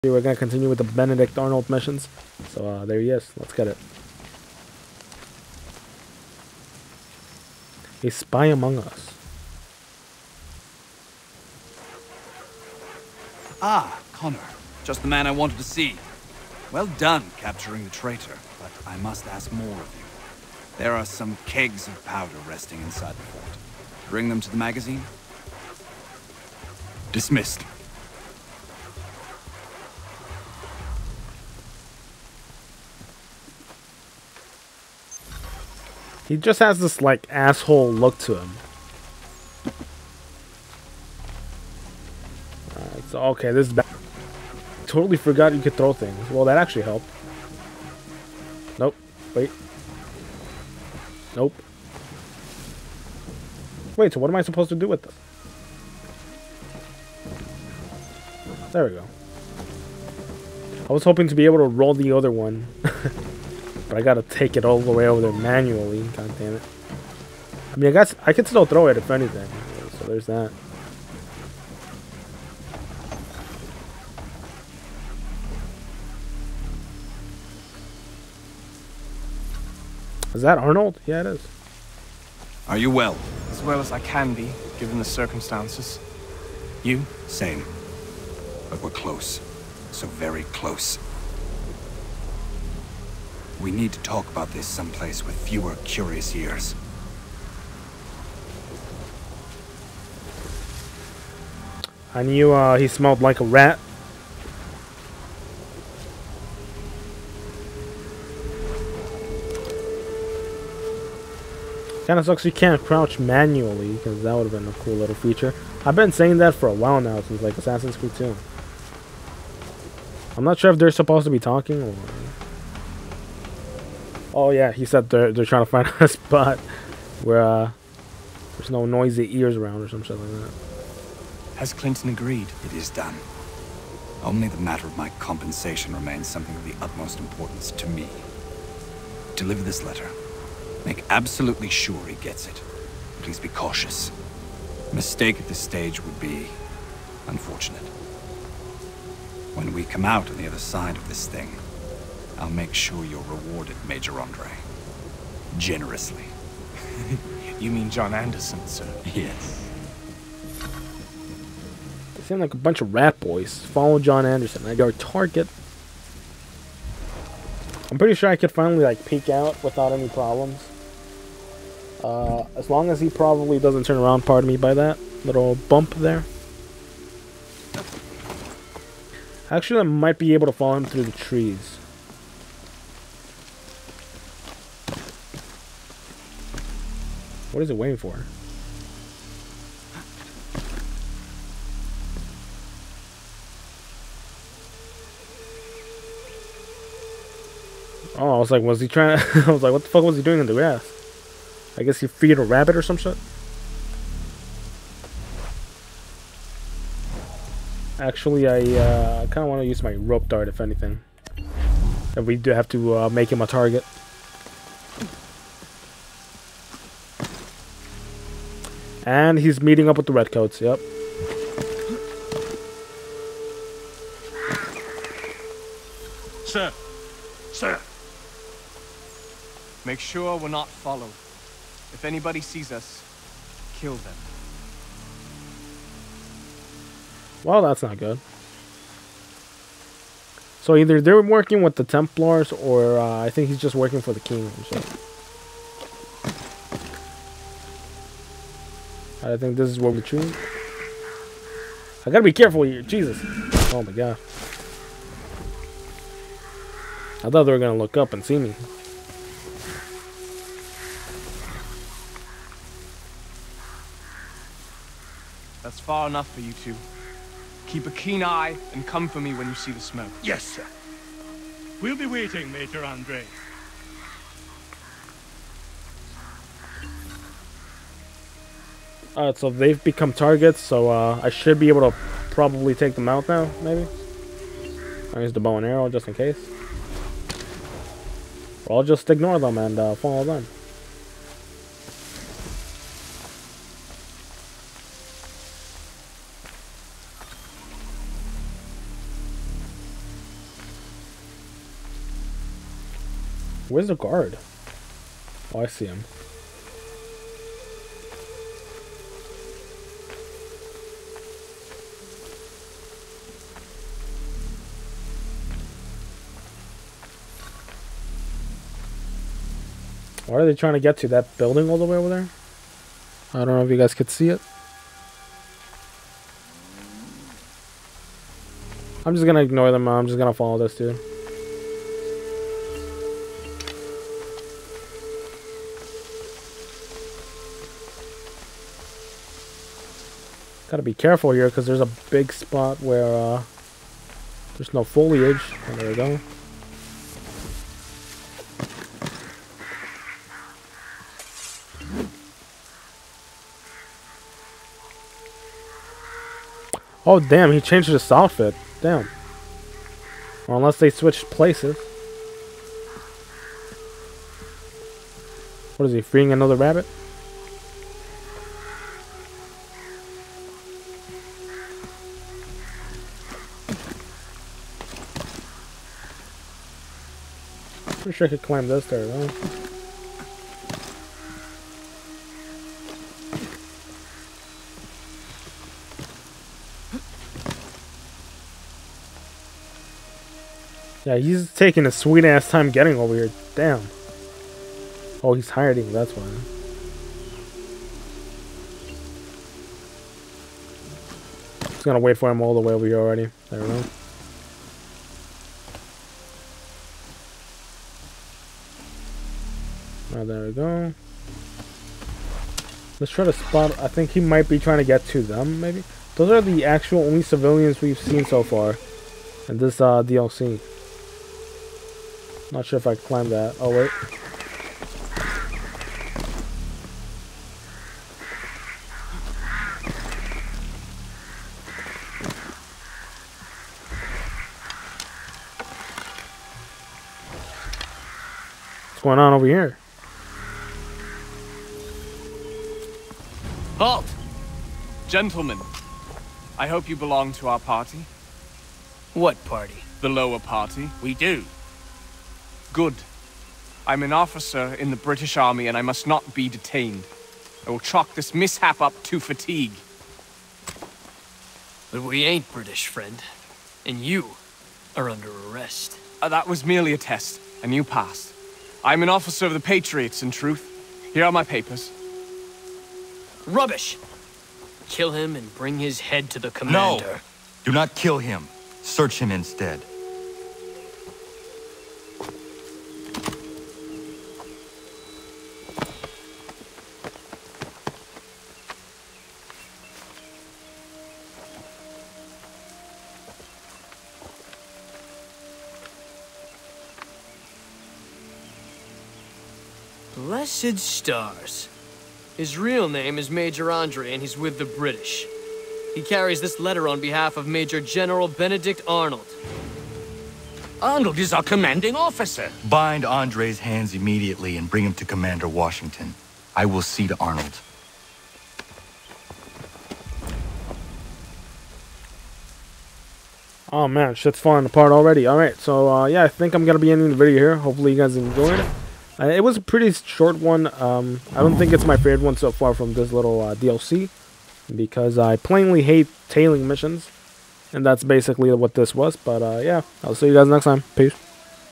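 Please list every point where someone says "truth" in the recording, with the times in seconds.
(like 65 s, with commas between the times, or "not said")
470 s.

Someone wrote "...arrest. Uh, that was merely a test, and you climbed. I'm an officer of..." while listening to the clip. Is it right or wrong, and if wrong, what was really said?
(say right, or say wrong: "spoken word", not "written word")
wrong: "passed", not "climbed".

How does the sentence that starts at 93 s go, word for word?
We need to talk about this someplace with fewer curious ears.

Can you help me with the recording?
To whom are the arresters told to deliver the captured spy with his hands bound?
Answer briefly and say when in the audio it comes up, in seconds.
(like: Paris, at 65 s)
Commander Washington, at 515 s.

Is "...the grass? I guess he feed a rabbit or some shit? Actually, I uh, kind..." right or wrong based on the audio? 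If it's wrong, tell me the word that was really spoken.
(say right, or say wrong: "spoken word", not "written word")
right.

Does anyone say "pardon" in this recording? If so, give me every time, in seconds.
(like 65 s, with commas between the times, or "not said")
174 s.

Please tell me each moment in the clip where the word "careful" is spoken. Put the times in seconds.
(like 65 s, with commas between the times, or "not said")
252 s, 340 s.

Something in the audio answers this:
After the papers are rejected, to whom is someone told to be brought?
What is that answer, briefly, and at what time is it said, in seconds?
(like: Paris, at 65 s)
The commander, at 476 s.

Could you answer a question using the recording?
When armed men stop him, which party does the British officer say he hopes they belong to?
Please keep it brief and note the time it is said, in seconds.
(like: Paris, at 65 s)
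The lower party, at 450 s.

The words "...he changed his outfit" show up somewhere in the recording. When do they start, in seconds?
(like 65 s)
357 s.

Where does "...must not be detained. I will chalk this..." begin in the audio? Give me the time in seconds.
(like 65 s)
455 s.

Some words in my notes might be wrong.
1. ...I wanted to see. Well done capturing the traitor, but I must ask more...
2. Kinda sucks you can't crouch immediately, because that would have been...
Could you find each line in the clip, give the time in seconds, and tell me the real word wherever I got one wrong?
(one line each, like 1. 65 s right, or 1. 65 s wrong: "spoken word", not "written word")
1. 15 s right
2. 112 s wrong: "manually", not "immediately".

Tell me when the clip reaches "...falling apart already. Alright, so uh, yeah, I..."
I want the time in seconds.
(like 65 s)
524 s.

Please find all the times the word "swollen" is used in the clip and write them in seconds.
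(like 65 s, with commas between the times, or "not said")
not said.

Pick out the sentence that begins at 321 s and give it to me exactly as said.
That building all the way over there?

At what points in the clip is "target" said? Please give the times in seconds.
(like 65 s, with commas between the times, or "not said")
164 s, 213 s, 280 s.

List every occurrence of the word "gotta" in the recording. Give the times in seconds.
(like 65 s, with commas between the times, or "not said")
64 s, 252 s, 340 s.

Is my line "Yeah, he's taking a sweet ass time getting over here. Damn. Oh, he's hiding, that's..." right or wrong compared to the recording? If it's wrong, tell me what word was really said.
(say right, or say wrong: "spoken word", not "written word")
right.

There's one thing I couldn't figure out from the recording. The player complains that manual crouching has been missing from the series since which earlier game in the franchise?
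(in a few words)
Assassin's Creed 2.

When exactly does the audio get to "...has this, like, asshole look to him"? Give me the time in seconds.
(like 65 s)
36 s.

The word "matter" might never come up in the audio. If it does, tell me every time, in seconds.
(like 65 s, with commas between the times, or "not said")
134 s.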